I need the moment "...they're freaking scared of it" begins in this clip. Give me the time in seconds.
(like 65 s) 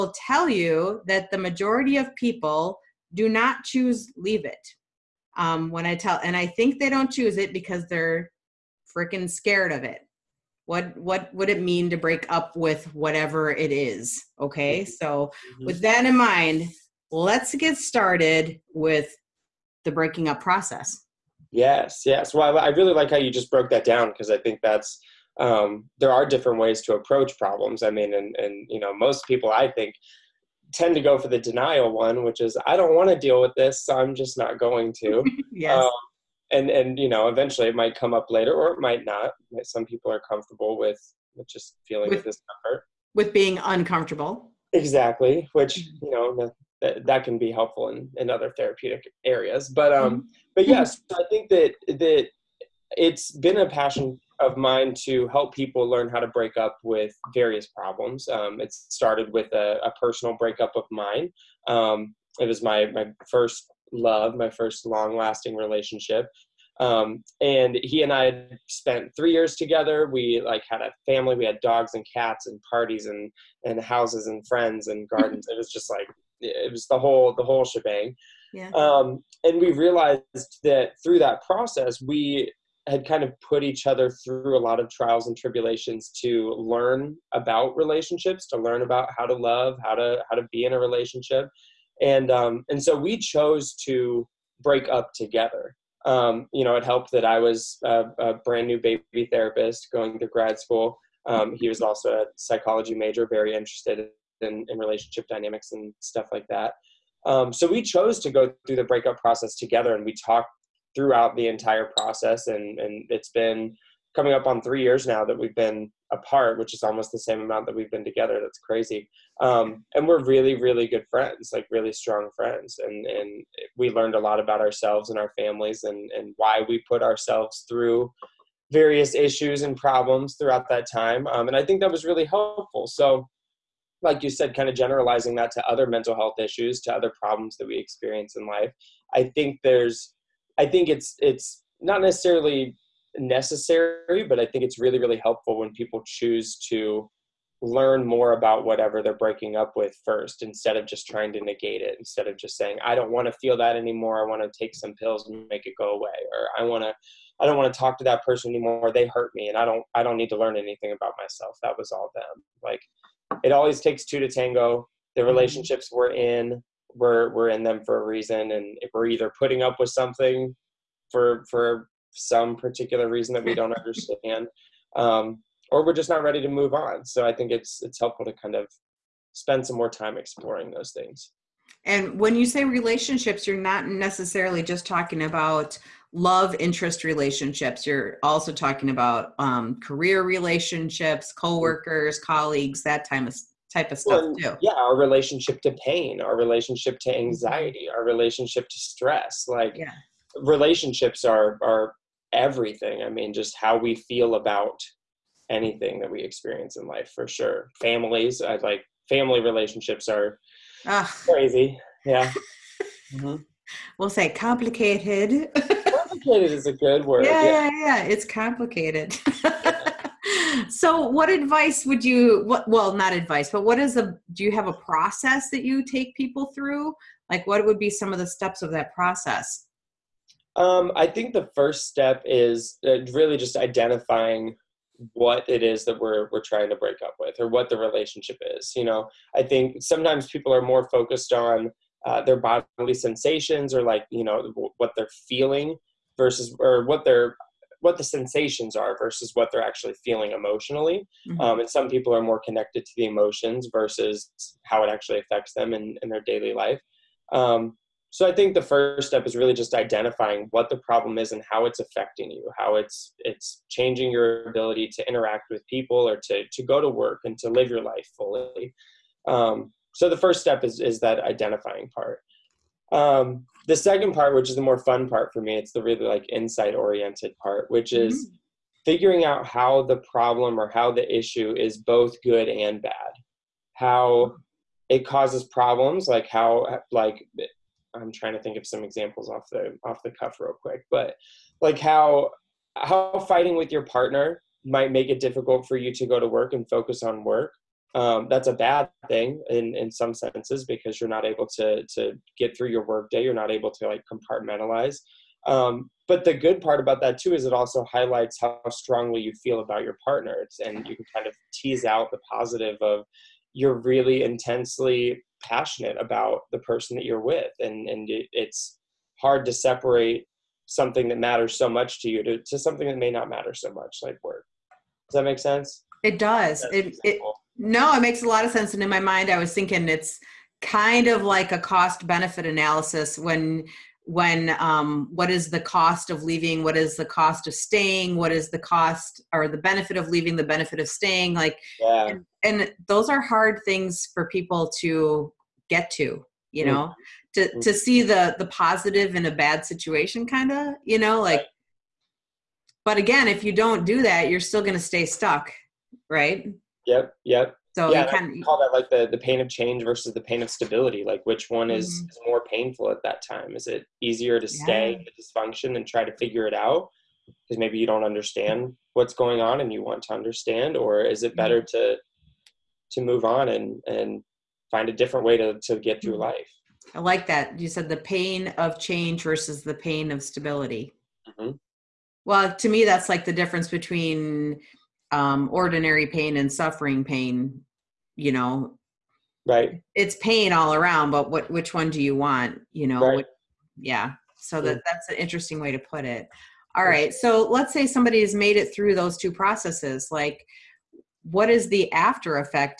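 7 s.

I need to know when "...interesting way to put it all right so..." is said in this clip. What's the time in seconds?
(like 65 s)
395 s.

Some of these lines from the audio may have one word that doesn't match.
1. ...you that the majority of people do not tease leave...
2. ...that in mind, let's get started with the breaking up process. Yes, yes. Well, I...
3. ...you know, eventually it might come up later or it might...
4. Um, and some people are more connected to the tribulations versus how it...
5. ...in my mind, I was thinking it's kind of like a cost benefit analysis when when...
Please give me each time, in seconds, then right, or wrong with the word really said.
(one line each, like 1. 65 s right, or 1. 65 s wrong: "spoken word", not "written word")
1. 0 s wrong: "choose", not "tease"
2. 15 s right
3. 36 s right
4. 251 s wrong: "emotions", not "tribulations"
5. 328 s right.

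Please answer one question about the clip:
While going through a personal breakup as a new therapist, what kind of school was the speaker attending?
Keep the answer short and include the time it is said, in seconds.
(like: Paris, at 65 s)
grad school, at 100 s.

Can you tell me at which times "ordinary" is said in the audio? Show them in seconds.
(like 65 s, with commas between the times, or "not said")
385 s.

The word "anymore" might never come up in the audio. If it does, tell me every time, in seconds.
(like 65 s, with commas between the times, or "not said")
153 s, 158 s.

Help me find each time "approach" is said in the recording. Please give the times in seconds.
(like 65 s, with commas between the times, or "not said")
26 s.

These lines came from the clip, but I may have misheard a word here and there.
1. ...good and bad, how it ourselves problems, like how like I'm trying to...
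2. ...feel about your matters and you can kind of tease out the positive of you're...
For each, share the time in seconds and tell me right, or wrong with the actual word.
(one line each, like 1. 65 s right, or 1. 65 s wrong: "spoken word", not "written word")
1. 282 s wrong: "causes", not "ourselves"
2. 309 s wrong: "partners", not "matters".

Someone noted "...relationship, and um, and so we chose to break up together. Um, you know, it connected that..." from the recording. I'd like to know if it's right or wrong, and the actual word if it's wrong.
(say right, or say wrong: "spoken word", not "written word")
wrong: "helped", not "connected".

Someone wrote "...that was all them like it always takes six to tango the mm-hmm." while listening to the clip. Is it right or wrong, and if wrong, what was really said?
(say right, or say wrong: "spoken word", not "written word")
wrong: "two", not "six".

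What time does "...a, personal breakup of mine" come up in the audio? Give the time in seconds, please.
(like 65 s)
59 s.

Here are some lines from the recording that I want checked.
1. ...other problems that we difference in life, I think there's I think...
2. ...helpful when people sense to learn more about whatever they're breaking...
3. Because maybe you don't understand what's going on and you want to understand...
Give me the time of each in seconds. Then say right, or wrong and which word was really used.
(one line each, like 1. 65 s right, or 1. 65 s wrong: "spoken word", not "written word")
1. 136 s wrong: "experience", not "difference"
2. 145 s wrong: "choose", not "sense"
3. 367 s right.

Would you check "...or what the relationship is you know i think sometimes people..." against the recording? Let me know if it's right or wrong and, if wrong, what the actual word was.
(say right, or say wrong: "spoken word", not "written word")
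right.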